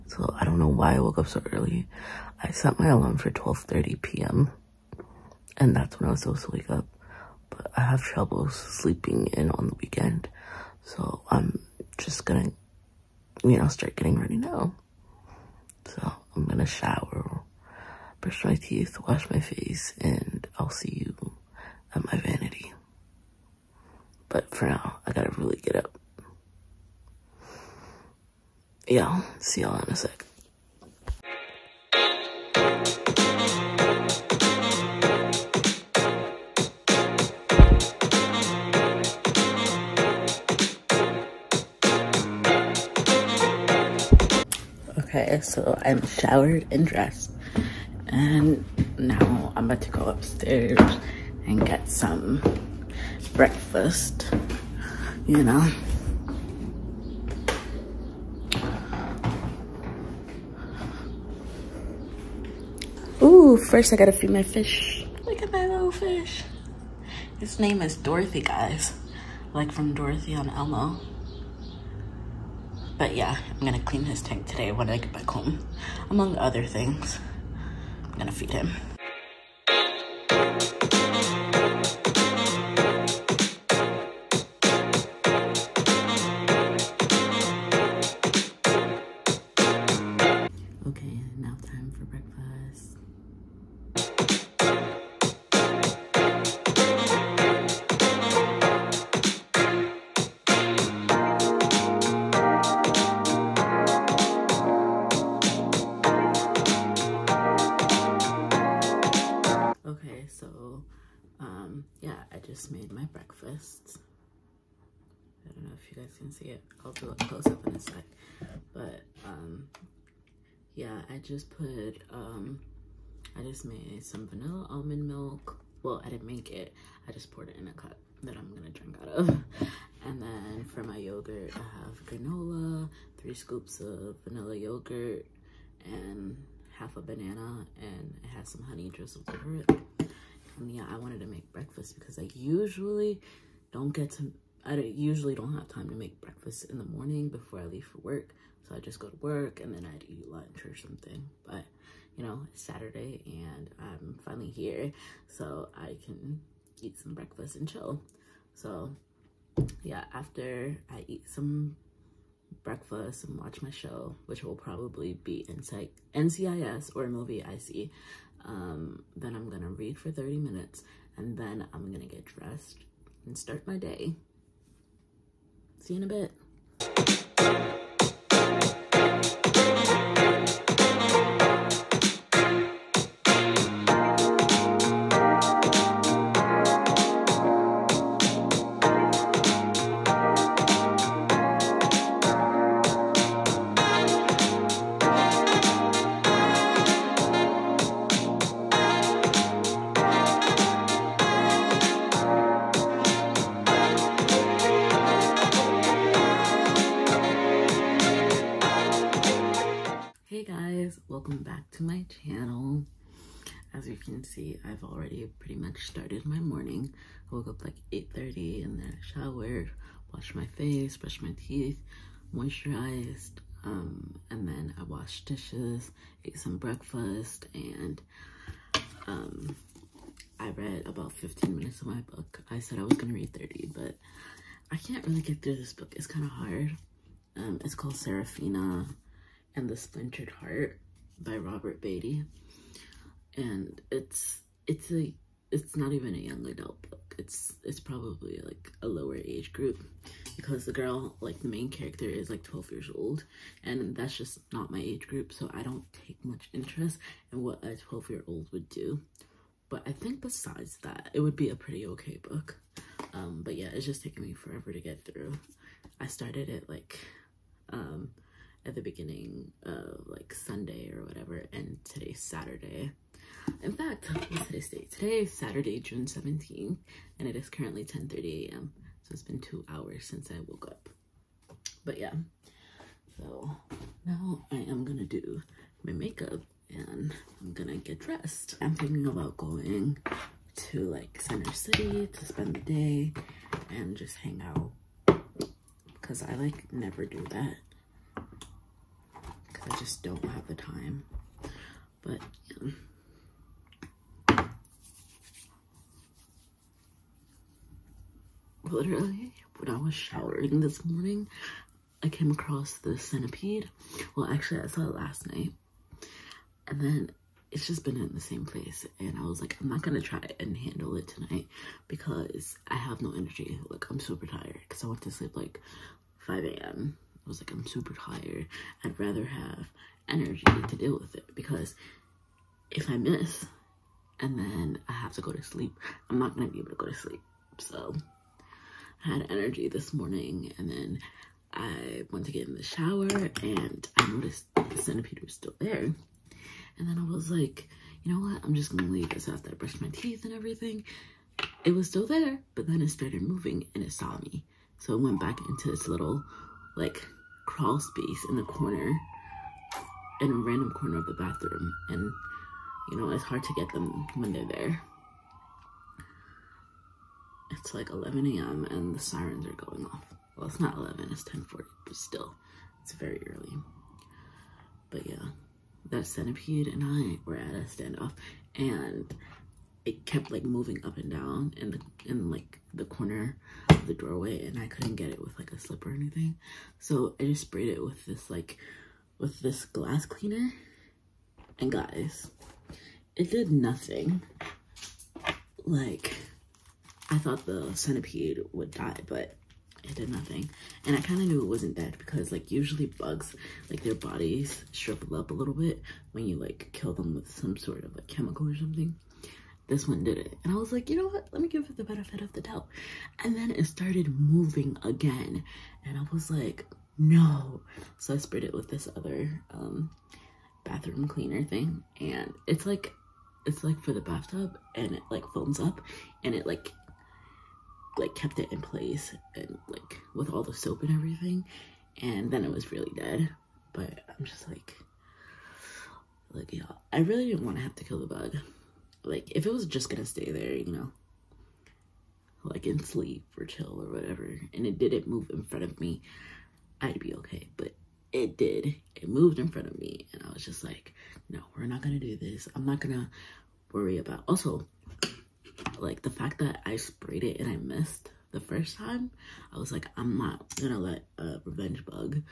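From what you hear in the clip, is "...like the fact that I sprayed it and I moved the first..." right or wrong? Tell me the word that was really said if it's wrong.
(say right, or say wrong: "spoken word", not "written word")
wrong: "missed", not "moved".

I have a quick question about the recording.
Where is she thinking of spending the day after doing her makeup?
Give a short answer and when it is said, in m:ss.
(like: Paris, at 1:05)
Center City, at 4:51.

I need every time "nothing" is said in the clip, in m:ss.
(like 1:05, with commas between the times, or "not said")
6:33, 6:40.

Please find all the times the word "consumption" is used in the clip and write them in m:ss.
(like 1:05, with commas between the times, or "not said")
not said.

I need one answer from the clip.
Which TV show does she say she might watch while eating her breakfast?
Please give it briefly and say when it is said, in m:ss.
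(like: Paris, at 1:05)
NCIS, at 2:45.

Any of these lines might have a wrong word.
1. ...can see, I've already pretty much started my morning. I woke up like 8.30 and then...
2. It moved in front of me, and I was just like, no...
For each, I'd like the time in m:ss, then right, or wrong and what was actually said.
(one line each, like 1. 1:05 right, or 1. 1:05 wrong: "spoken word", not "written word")
1. 3:33 right
2. 7:28 right.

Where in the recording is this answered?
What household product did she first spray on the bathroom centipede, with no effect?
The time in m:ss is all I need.
6:29.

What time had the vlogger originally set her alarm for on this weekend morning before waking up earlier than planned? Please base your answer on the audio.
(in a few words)
12:30 p.m.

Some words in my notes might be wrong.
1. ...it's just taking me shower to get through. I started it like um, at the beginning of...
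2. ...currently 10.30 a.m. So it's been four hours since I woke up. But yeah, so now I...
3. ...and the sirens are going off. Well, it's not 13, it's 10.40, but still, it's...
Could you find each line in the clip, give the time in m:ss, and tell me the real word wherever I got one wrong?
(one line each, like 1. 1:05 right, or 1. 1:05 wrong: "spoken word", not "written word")
1. 4:23 wrong: "forever", not "shower"
2. 4:37 wrong: "two", not "four"
3. 6:08 wrong: "11", not "13".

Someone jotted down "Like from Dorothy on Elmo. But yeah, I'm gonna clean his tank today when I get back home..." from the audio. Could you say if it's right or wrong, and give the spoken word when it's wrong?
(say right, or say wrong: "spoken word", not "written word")
right.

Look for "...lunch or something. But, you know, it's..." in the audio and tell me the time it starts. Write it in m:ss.
2:30.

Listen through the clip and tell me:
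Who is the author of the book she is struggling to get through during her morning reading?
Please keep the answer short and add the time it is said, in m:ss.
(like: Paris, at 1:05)
Robert Beatty, at 4:01.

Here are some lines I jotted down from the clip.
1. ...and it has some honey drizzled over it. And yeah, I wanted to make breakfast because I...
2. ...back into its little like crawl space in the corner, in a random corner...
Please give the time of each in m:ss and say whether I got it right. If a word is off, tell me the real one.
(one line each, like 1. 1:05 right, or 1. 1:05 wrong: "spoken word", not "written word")
1. 2:17 right
2. 5:55 right.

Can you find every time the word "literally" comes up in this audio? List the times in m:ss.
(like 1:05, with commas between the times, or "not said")
5:08.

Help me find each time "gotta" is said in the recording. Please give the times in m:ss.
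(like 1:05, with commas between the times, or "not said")
0:25, 1:03.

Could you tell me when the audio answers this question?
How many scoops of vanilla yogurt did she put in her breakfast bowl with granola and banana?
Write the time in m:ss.
2:13.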